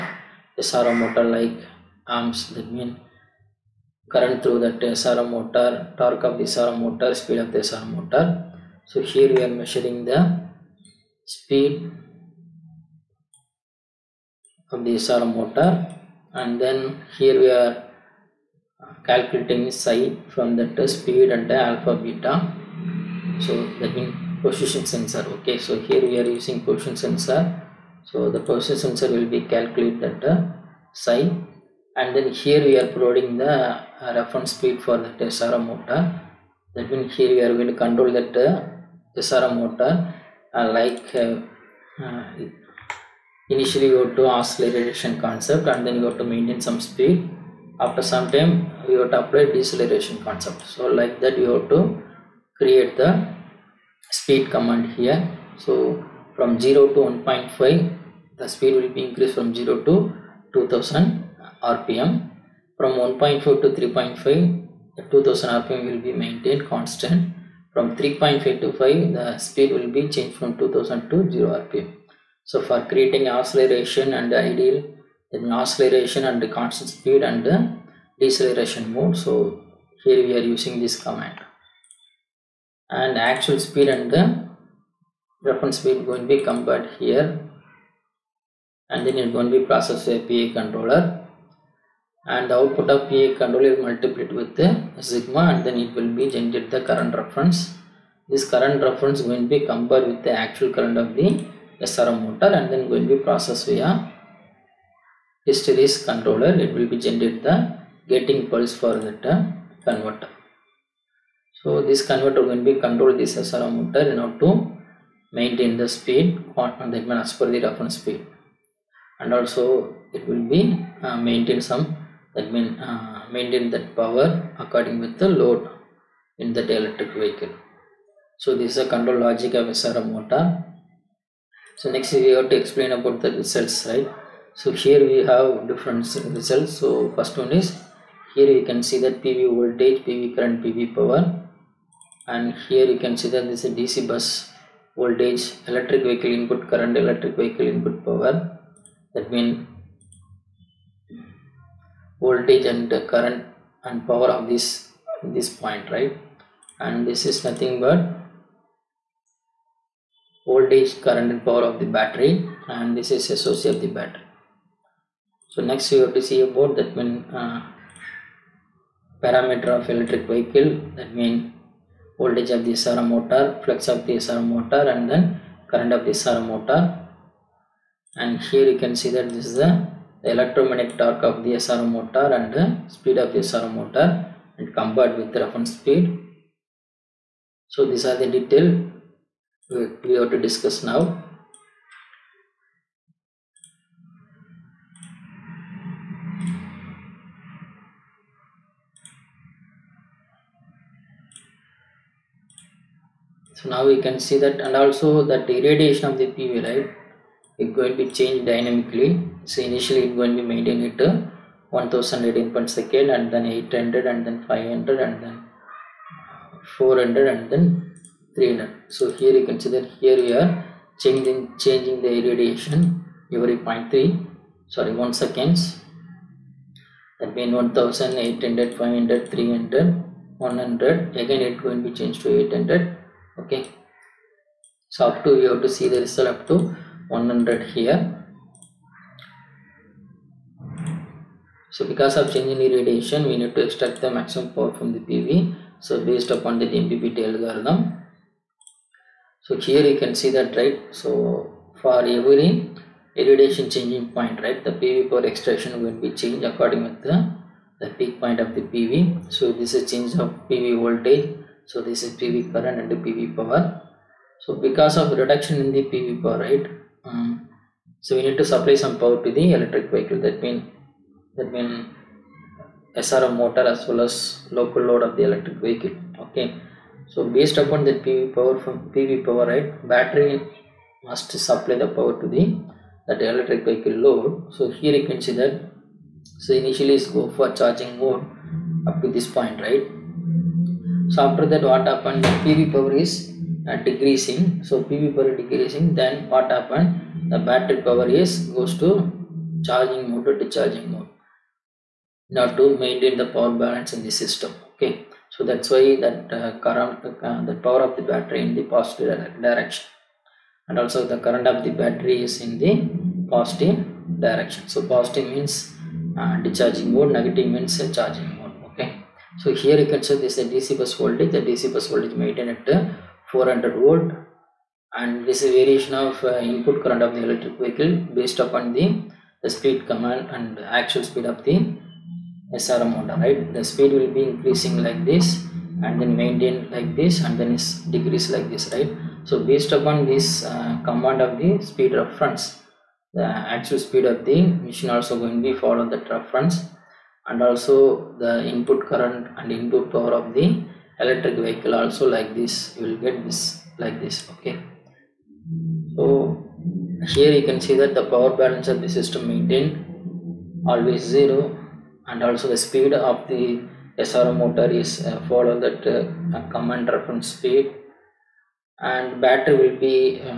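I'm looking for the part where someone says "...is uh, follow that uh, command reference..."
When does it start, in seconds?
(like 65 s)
364 s.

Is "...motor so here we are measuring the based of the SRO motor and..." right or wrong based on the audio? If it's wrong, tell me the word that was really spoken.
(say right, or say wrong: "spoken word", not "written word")
wrong: "speed", not "based".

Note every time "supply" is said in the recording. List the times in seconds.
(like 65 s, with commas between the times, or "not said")
268 s, 281 s.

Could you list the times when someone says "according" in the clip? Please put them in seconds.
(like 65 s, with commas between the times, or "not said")
124 s, 256 s.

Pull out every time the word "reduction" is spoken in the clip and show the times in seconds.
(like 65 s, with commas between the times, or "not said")
265 s.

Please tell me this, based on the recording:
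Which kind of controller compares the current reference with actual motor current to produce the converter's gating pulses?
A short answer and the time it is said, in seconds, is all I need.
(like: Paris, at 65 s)
hysteresis controller, at 105 s.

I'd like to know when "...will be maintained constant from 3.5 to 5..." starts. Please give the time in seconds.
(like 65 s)
65 s.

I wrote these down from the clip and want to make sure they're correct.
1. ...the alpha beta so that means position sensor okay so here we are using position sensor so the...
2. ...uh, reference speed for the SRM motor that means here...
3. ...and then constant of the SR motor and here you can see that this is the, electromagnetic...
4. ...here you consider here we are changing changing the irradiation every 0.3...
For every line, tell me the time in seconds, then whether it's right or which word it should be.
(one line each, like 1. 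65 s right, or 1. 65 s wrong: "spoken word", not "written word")
1. 21 s right
2. 33 s right
3. 174 s wrong: "current", not "constant"
4. 219 s right.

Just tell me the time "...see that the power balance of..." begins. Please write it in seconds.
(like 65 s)
357 s.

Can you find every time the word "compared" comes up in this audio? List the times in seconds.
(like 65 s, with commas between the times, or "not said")
86 s, 99 s, 184 s.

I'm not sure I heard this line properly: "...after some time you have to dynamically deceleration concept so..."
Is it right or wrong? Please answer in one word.
wrong.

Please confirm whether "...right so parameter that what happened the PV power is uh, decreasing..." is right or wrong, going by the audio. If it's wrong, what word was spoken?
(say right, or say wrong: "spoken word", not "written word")
wrong: "after", not "parameter".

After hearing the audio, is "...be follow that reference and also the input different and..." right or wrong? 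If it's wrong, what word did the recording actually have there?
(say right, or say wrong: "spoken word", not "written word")
wrong: "current", not "different".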